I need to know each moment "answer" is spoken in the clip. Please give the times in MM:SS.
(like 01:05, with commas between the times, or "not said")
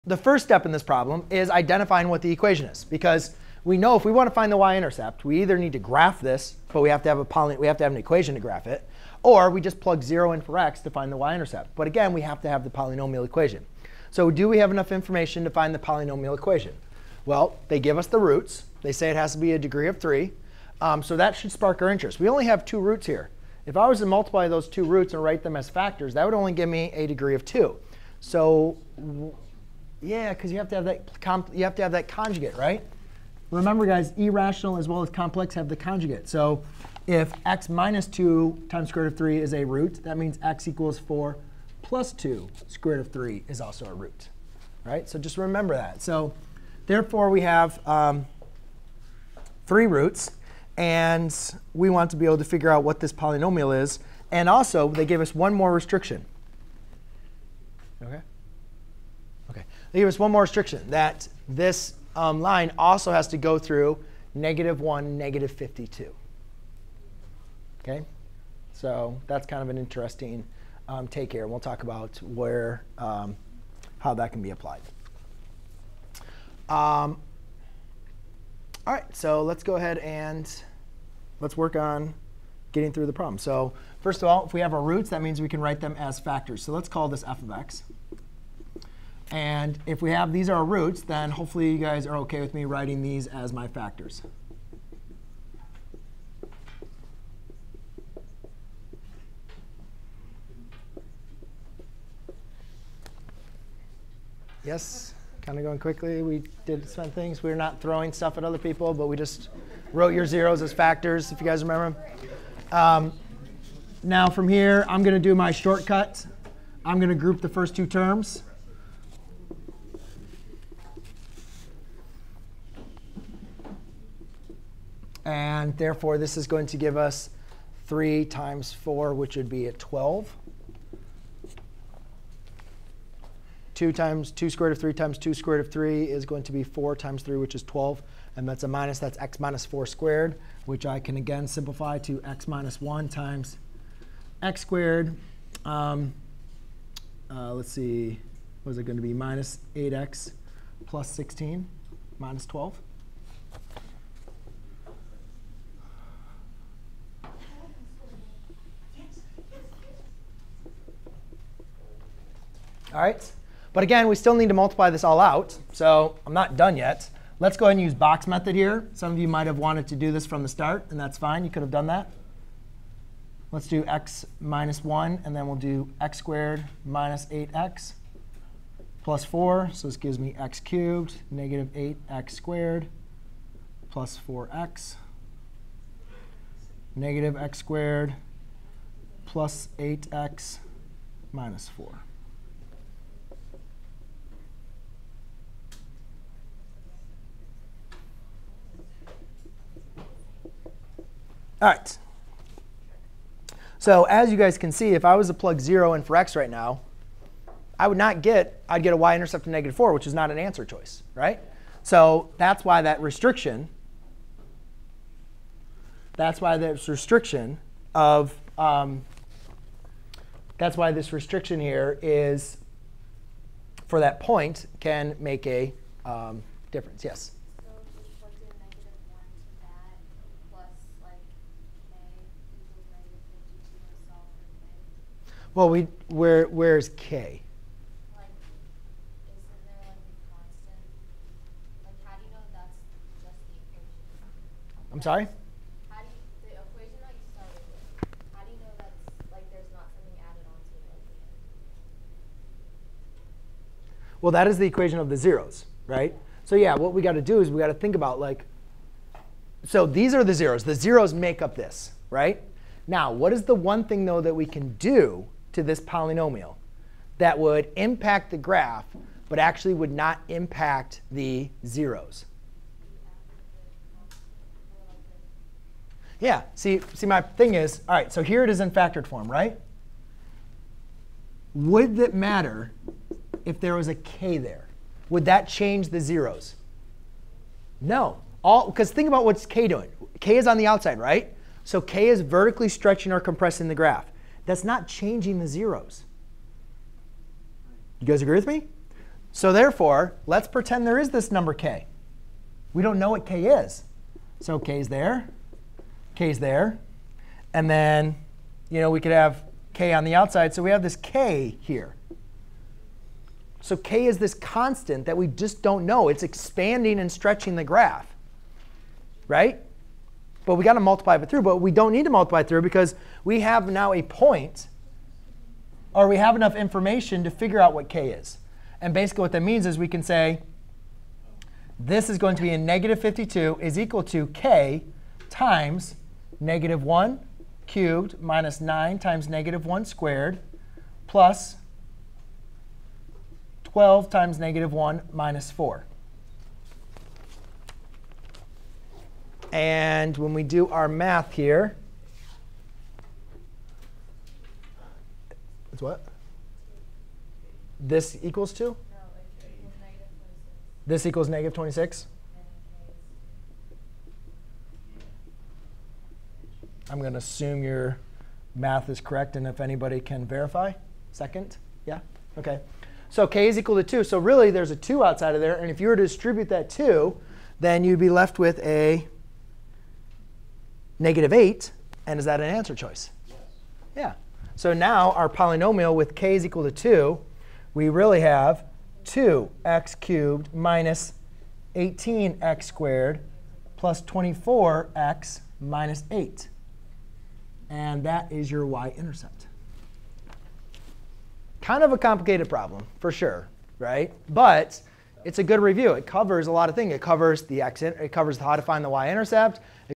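03:30, 06:22.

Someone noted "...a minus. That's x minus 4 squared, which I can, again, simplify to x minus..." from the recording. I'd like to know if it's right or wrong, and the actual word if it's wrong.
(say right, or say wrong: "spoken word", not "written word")
right.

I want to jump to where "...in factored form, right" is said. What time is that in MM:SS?
04:38.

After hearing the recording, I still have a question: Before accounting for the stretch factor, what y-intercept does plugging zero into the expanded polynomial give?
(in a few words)
-4.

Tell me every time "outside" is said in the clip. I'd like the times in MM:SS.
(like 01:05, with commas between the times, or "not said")
04:50, 05:10, 06:15.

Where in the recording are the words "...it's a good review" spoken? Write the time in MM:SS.
06:45.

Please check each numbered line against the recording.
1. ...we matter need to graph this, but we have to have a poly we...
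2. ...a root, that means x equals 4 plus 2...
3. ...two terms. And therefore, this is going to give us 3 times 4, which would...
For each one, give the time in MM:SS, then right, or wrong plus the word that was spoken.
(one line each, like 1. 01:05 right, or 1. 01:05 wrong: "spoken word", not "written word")
1. 00:05 wrong: "either", not "matter"
2. 00:39 right
3. 01:57 right.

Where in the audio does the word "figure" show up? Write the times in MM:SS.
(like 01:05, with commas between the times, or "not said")
00:52, 05:27.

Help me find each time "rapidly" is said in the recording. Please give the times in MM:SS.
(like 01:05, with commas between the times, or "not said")
not said.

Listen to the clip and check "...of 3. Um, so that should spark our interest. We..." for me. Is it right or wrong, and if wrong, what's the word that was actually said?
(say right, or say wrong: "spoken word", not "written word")
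right.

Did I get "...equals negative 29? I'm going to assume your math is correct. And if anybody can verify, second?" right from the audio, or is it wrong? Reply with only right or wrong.
wrong.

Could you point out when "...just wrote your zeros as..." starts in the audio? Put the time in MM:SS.
01:49.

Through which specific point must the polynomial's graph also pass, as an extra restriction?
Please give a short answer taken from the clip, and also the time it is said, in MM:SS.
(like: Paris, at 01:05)
(-1, -52), at 01:04.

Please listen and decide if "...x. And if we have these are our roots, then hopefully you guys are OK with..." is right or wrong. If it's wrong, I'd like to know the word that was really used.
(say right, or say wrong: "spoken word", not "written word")
right.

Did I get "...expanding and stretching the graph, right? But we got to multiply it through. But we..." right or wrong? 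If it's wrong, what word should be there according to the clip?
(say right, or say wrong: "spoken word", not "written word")
right.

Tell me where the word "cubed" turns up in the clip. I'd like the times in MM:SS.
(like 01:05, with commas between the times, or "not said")
03:00, 05:37, 06:29.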